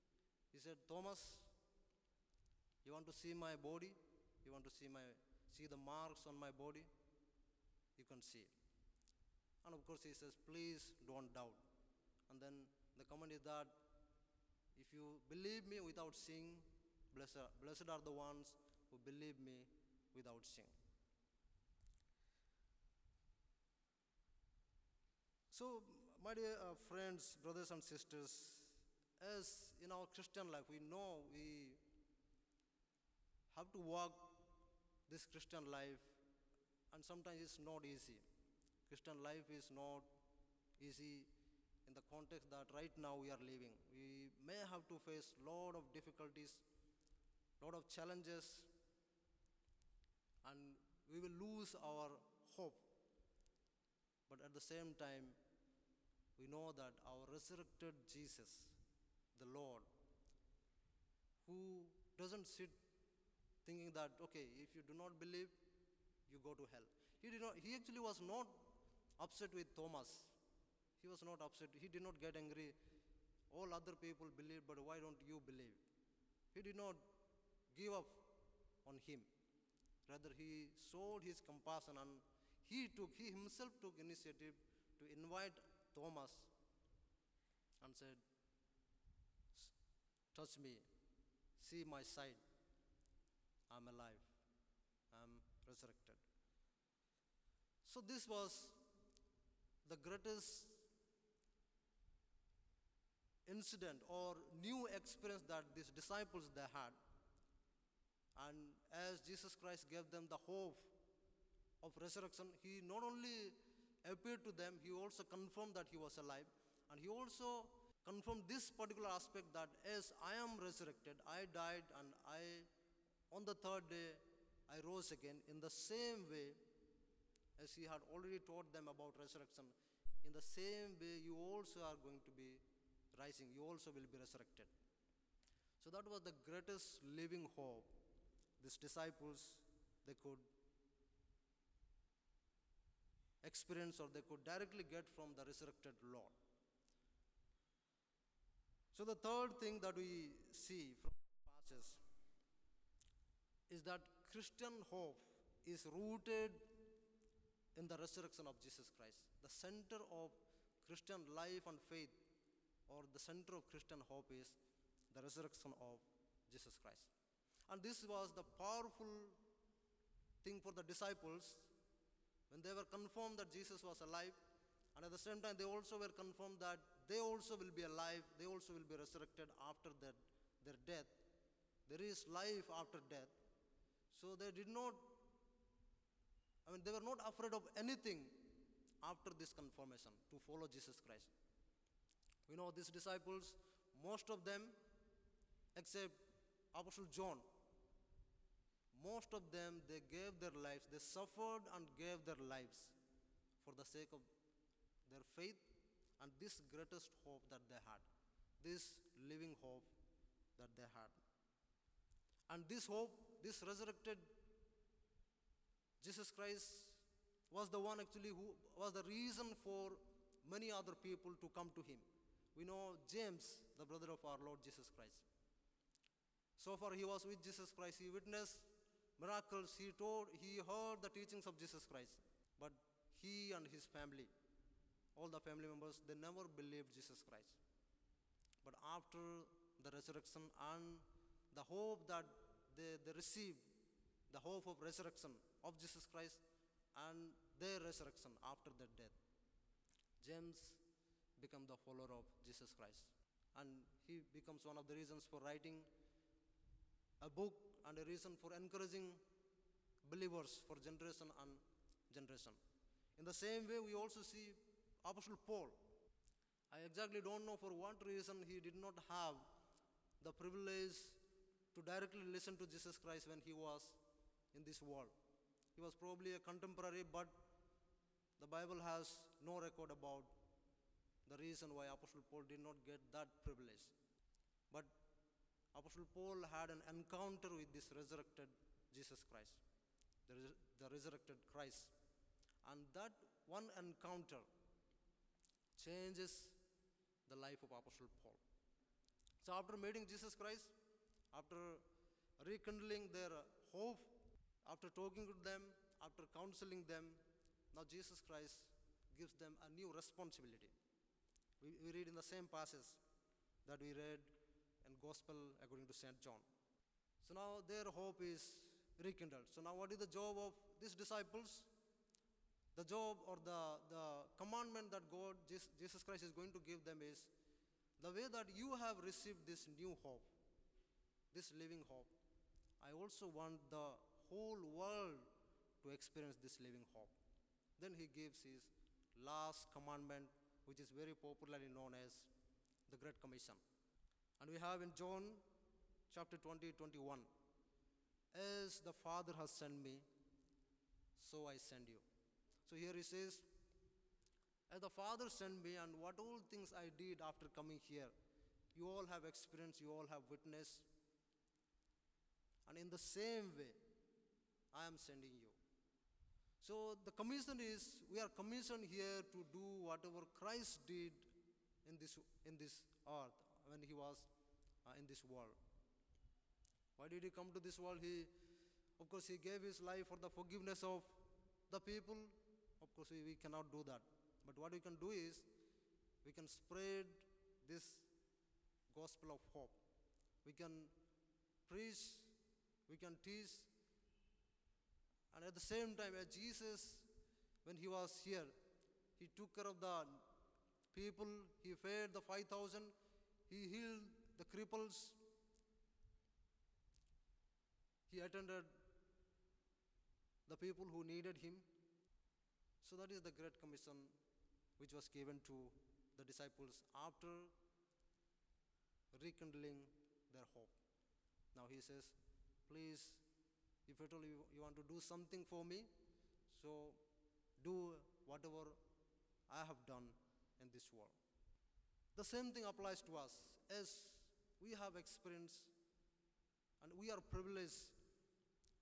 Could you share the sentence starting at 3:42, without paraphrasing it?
We know James, the brother of our Lord Jesus Christ.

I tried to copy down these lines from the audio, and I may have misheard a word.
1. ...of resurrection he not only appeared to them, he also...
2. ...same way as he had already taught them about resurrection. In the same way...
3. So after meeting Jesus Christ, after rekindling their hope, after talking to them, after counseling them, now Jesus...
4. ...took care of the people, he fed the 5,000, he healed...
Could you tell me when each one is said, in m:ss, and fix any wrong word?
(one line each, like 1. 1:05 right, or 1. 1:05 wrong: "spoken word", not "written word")
1. 1:51 right
2. 2:05 right
3. 4:59 right
4. 6:39 right.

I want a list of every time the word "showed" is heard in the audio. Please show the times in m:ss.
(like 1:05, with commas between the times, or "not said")
1:20.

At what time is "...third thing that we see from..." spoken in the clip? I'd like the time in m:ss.
2:29.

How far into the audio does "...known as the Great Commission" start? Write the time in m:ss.
5:41.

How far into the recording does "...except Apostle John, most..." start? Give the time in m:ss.
3:15.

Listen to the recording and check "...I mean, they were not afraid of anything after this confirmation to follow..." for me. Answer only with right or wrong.
right.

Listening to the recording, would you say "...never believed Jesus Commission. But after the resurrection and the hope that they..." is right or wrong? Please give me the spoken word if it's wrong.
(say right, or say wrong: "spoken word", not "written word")
wrong: "Christ", not "Commission".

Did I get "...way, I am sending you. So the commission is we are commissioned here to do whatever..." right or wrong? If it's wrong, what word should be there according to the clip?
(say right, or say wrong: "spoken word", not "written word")
right.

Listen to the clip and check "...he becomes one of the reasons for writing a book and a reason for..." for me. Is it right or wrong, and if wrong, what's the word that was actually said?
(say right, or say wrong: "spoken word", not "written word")
right.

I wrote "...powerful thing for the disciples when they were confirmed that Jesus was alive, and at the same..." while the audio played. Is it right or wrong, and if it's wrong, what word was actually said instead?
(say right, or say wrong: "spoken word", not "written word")
right.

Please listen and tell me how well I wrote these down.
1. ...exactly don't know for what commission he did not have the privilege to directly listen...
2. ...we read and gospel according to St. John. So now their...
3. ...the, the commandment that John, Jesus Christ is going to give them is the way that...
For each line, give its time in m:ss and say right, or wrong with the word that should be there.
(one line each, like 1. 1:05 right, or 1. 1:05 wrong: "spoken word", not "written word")
1. 4:26 wrong: "reason", not "commission"
2. 5:13 right
3. 5:23 wrong: "God", not "John".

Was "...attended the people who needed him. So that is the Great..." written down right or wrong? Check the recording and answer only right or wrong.
right.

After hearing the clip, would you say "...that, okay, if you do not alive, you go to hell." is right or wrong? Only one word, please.
wrong.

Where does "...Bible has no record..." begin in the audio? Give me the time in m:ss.
4:38.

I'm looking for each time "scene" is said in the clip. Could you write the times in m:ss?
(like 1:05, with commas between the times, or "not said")
not said.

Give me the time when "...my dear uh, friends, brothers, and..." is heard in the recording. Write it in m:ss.
0:26.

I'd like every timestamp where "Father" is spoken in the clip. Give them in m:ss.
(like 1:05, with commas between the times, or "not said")
5:48, 5:54.